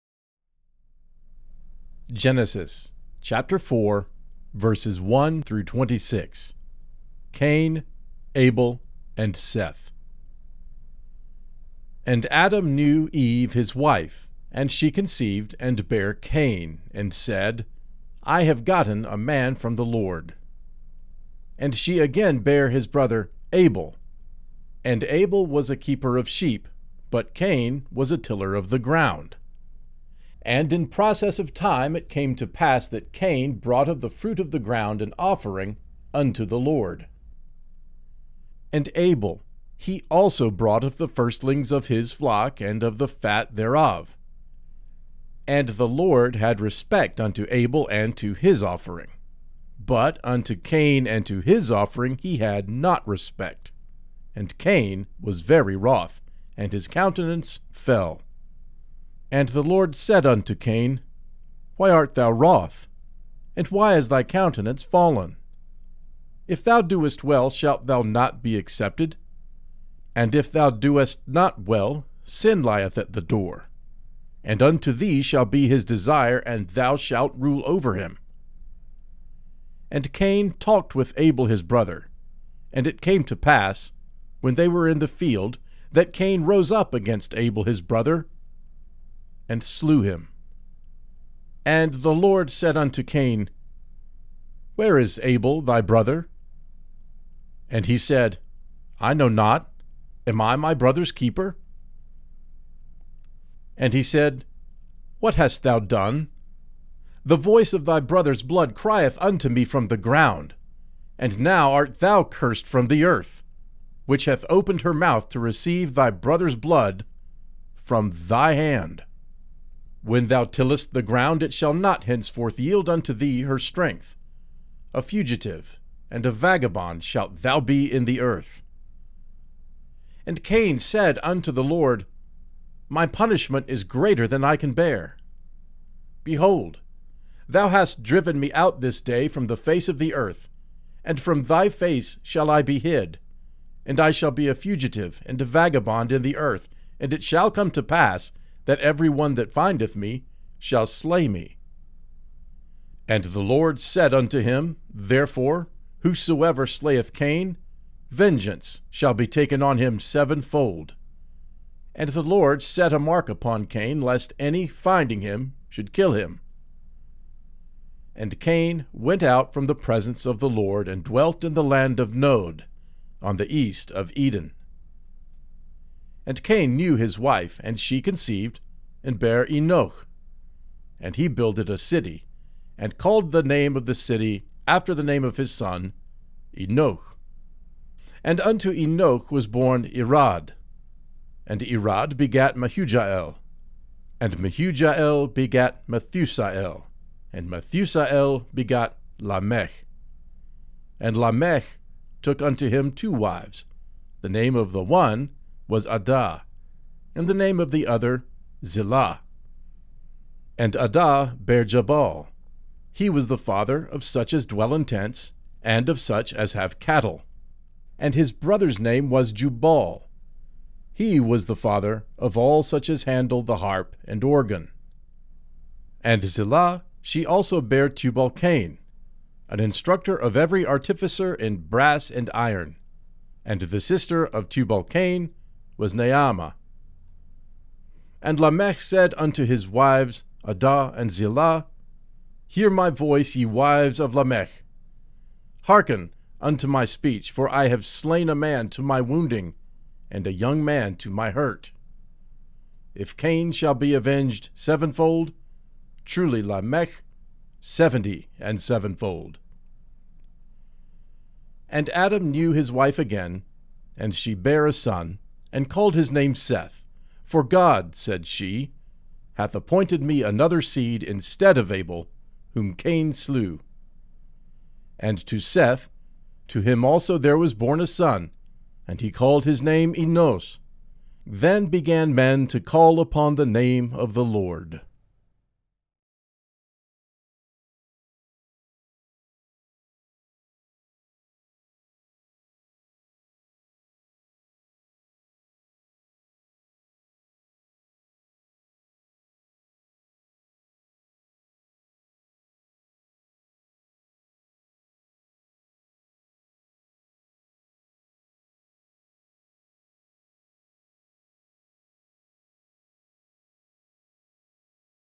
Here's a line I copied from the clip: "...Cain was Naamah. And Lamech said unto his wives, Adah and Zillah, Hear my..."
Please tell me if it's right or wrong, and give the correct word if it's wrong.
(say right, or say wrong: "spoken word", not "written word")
right.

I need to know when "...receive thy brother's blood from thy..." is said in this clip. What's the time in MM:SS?
01:55.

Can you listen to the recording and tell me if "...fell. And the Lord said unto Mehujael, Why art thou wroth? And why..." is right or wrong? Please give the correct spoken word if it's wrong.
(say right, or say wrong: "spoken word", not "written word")
wrong: "Cain", not "Mehujael".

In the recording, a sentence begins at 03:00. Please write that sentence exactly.
And he builded a city, and called the name of the city after the name of his son, Enoch.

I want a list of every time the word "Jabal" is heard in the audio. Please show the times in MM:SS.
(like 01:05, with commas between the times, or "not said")
03:31.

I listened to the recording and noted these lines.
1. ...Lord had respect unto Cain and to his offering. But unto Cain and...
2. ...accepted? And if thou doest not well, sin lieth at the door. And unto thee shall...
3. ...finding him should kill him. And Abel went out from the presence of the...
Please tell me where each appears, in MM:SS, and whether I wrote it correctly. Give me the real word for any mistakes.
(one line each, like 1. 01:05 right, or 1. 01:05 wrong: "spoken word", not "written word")
1. 00:45 wrong: "Abel", not "Cain"
2. 01:08 right
3. 02:44 wrong: "Cain", not "Abel".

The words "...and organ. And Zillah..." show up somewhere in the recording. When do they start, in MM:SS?
03:44.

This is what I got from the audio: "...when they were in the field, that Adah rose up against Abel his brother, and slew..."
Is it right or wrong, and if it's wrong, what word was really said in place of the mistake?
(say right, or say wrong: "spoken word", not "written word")
wrong: "Cain", not "Adah".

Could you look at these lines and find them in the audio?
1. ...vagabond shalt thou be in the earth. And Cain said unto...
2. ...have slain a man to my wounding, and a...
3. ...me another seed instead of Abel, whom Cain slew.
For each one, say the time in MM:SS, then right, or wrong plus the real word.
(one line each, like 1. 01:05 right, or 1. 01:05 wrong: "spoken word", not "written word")
1. 02:06 right
2. 04:07 right
3. 04:30 right.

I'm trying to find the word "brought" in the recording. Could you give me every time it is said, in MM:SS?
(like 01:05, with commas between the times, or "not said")
00:33, 00:40.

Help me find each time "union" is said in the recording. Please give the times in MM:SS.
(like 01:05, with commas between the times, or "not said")
not said.